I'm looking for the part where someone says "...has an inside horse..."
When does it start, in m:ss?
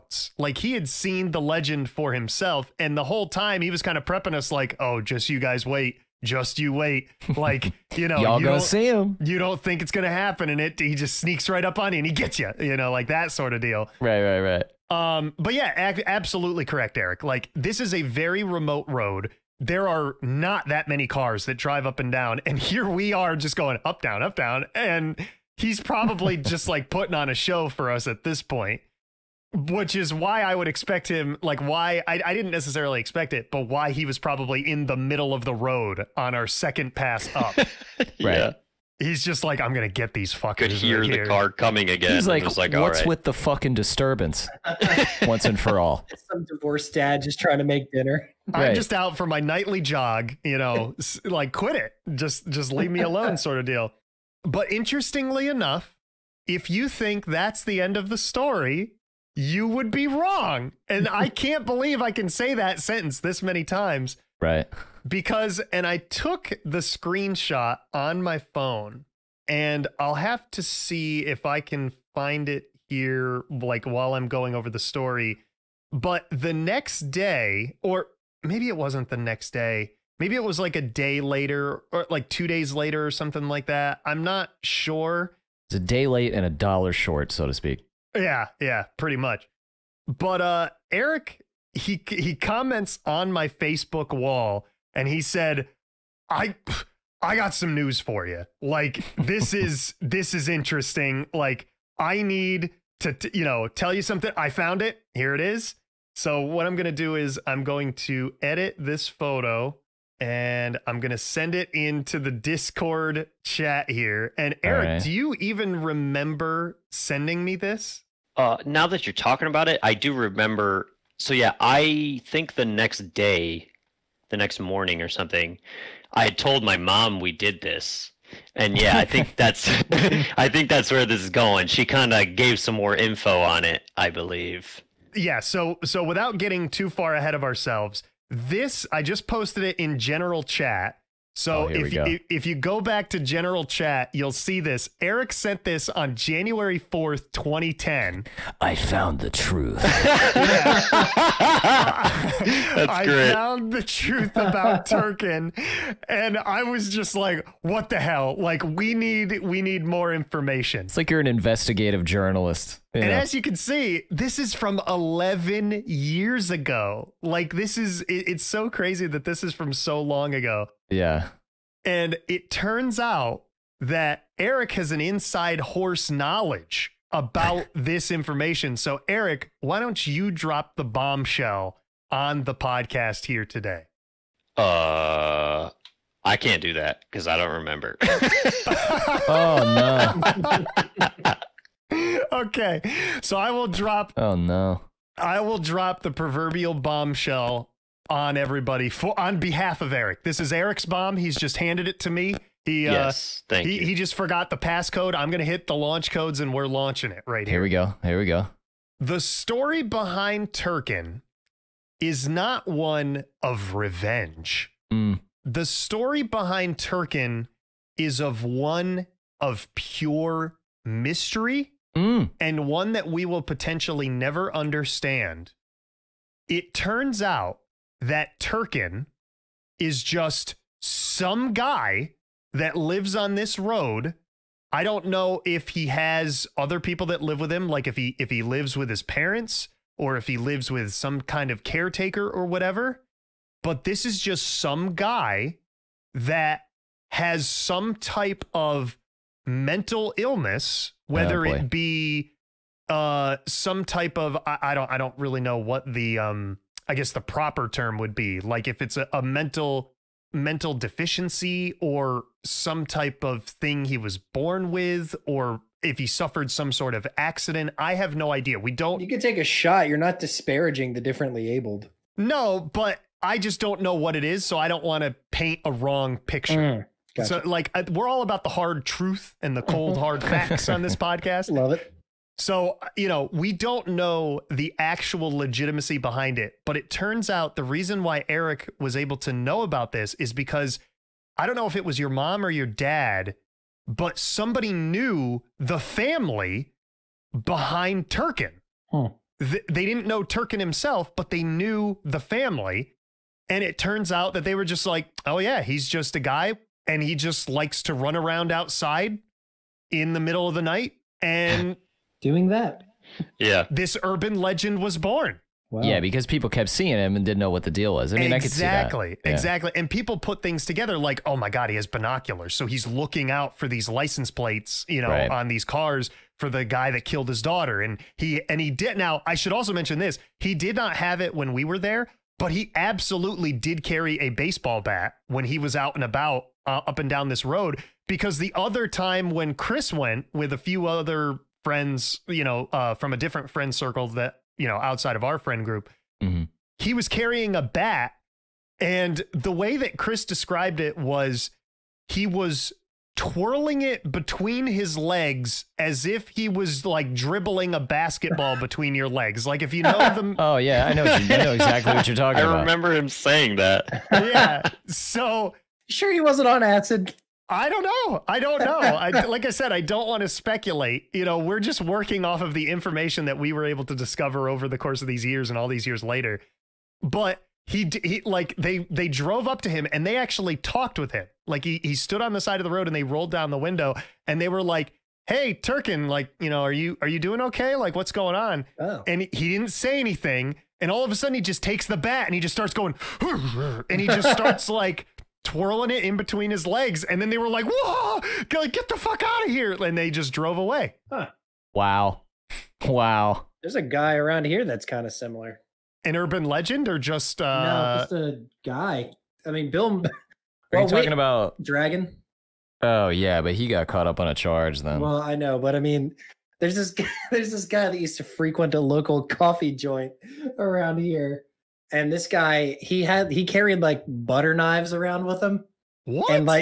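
2:54.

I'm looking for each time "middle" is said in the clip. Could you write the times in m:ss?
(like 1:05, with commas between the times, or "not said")
0:34, 5:10.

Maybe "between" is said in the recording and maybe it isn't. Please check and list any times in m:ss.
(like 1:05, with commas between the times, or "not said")
5:54, 5:58, 6:36.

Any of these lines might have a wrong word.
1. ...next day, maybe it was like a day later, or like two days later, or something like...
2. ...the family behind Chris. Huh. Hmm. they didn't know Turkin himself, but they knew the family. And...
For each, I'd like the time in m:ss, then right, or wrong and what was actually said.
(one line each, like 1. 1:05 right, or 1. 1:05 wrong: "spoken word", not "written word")
1. 1:19 right
2. 4:55 wrong: "Turkin", not "Chris".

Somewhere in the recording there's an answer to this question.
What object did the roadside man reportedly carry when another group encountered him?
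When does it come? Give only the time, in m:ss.
5:34.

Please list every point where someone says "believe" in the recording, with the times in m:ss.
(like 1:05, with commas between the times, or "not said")
1:01, 2:14.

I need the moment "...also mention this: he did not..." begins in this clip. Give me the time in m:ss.
5:29.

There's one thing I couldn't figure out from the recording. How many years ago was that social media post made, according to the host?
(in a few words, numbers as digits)
11.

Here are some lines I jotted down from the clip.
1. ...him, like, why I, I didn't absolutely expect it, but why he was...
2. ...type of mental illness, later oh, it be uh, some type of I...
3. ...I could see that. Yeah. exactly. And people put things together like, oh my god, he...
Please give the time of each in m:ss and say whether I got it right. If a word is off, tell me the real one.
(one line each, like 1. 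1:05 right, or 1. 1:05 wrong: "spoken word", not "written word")
1. 0:31 wrong: "necessarily", not "absolutely"
2. 4:07 wrong: "whether", not "later"
3. 5:18 right.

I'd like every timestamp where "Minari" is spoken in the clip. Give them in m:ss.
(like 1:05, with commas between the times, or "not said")
not said.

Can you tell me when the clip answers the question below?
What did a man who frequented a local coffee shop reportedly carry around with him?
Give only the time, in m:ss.
7:04.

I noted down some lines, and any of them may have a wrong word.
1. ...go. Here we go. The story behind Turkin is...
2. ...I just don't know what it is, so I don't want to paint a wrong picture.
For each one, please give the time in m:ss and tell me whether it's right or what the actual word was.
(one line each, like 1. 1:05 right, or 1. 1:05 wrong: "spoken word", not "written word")
1. 3:27 right
2. 4:33 right.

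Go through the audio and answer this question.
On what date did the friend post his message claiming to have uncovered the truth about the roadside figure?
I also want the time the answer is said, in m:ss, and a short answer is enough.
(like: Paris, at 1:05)
January 4th, 2010, at 2:26.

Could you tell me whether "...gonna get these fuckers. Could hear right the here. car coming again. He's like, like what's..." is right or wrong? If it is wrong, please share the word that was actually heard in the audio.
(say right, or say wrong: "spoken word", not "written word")
right.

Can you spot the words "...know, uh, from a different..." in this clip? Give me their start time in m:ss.
5:42.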